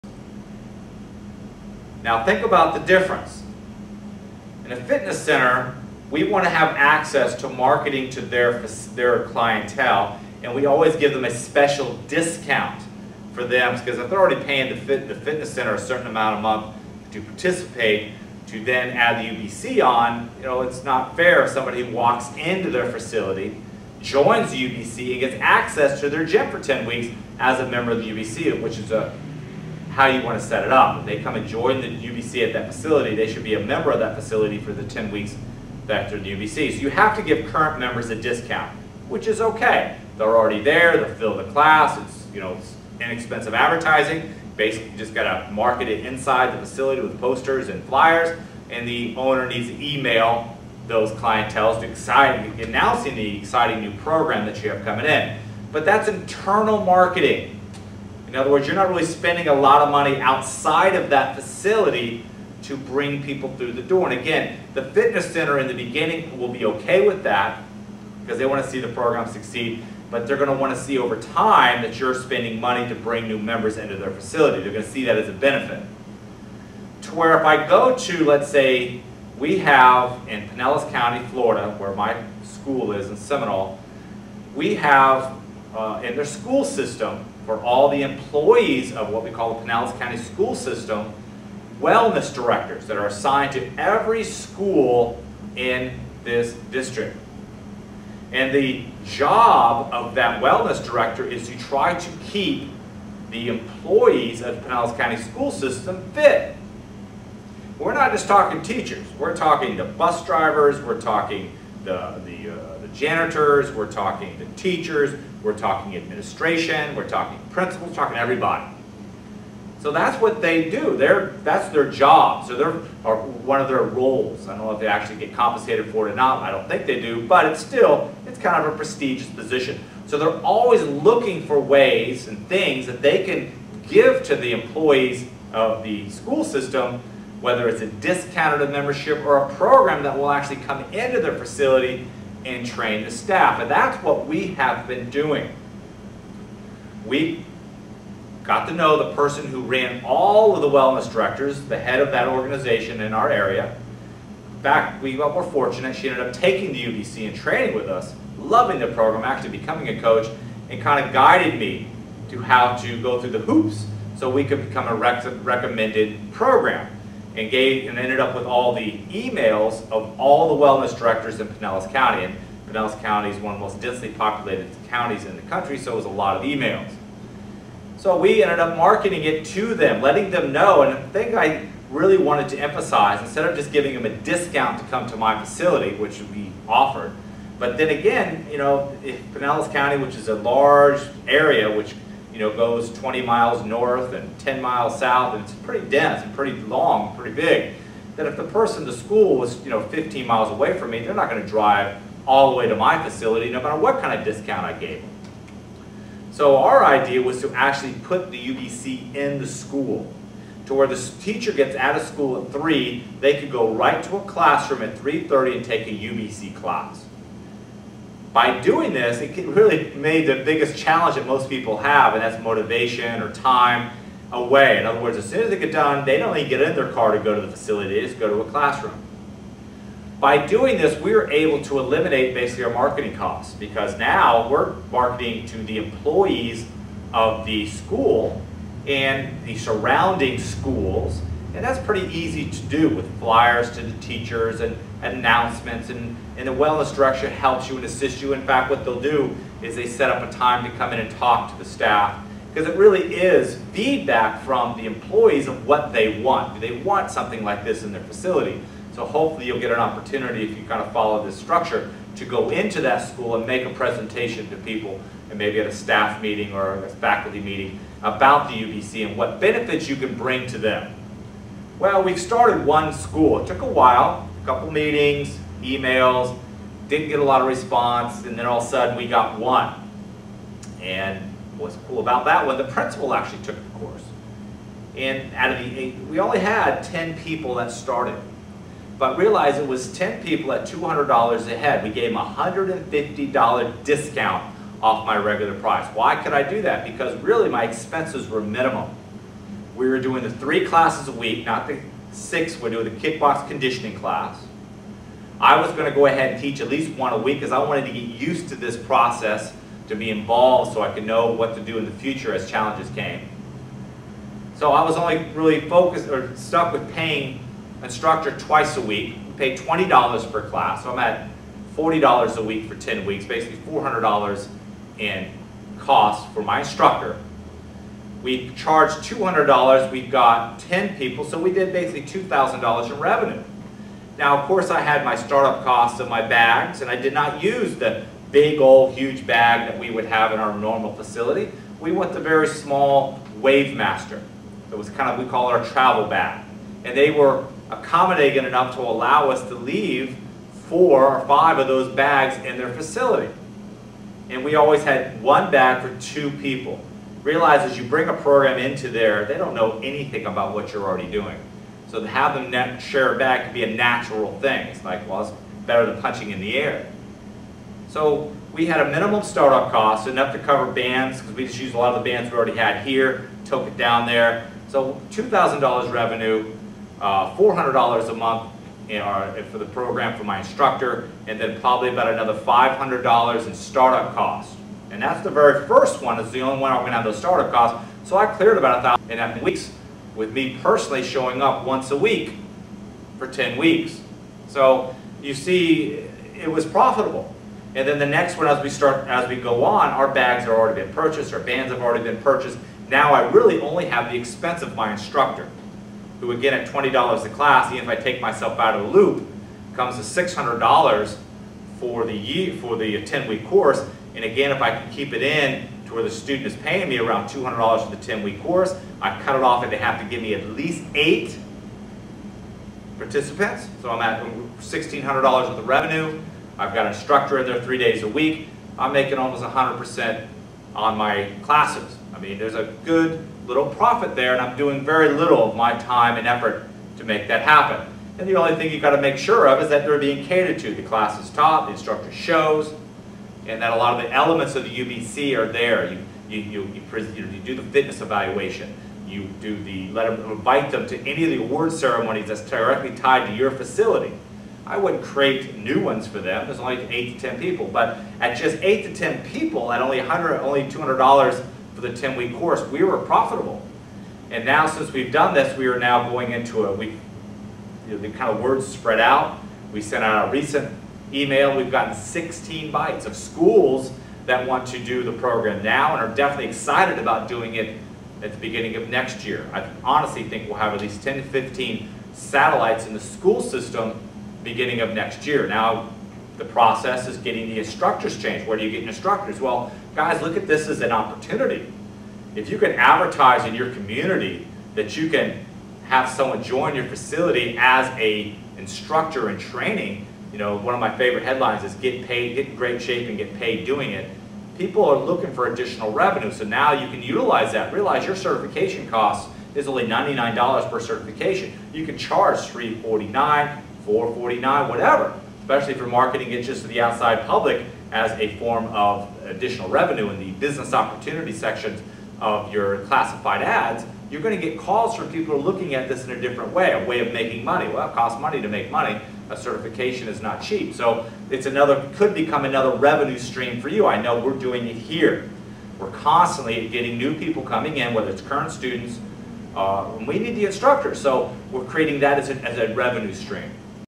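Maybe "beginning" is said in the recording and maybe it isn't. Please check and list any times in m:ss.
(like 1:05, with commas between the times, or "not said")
1:05, 7:58, 8:04.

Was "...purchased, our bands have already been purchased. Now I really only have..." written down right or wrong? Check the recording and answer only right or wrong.
right.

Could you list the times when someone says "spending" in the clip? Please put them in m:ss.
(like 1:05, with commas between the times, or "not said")
0:59, 1:12.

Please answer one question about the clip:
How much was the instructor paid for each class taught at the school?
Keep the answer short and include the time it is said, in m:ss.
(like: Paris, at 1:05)
$20, at 5:19.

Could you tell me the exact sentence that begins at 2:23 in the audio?
And that's what we have been doing.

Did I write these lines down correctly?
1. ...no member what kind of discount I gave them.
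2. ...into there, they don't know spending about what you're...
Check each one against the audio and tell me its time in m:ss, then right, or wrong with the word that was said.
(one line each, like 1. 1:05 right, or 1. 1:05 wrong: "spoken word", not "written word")
1. 3:23 wrong: "matter", not "member"
2. 5:58 wrong: "anything", not "spending".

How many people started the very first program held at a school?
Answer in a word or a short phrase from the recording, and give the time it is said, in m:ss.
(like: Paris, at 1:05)
10, at 4:46.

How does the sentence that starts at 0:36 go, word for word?
So you have to give current members a discount, which is okay.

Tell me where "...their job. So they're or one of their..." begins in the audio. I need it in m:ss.
2:01.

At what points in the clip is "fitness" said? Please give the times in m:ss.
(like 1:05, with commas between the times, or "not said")
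0:04, 0:15, 1:04, 7:27.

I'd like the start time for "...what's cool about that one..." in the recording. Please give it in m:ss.
4:41.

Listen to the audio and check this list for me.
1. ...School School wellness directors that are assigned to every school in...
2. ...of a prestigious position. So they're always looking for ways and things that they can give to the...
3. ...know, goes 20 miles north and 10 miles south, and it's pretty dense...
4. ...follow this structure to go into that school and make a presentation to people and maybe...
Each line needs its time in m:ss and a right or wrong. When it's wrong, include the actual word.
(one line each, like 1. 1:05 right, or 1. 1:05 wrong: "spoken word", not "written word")
1. 1:30 wrong: "System", not "School"
2. 2:08 right
3. 3:12 right
4. 4:20 right.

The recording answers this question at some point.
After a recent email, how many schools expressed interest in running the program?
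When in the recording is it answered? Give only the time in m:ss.
7:51.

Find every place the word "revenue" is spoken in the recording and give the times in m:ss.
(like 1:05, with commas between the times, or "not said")
5:32, 6:15, 7:05, 8:25, 8:39, 8:52, 9:02.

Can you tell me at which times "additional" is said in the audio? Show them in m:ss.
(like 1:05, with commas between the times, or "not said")
8:25, 8:39.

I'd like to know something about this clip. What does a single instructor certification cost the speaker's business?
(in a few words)
$99.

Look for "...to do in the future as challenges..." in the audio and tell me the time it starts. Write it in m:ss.
5:11.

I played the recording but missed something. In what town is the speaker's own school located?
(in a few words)
Seminole.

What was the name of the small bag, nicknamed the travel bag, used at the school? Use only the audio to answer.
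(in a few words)
Wavemaster.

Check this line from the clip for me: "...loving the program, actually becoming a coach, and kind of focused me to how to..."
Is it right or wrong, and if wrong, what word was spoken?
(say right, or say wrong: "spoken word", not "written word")
wrong: "guided", not "focused".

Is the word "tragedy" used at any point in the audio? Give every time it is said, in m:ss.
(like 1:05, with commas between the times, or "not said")
not said.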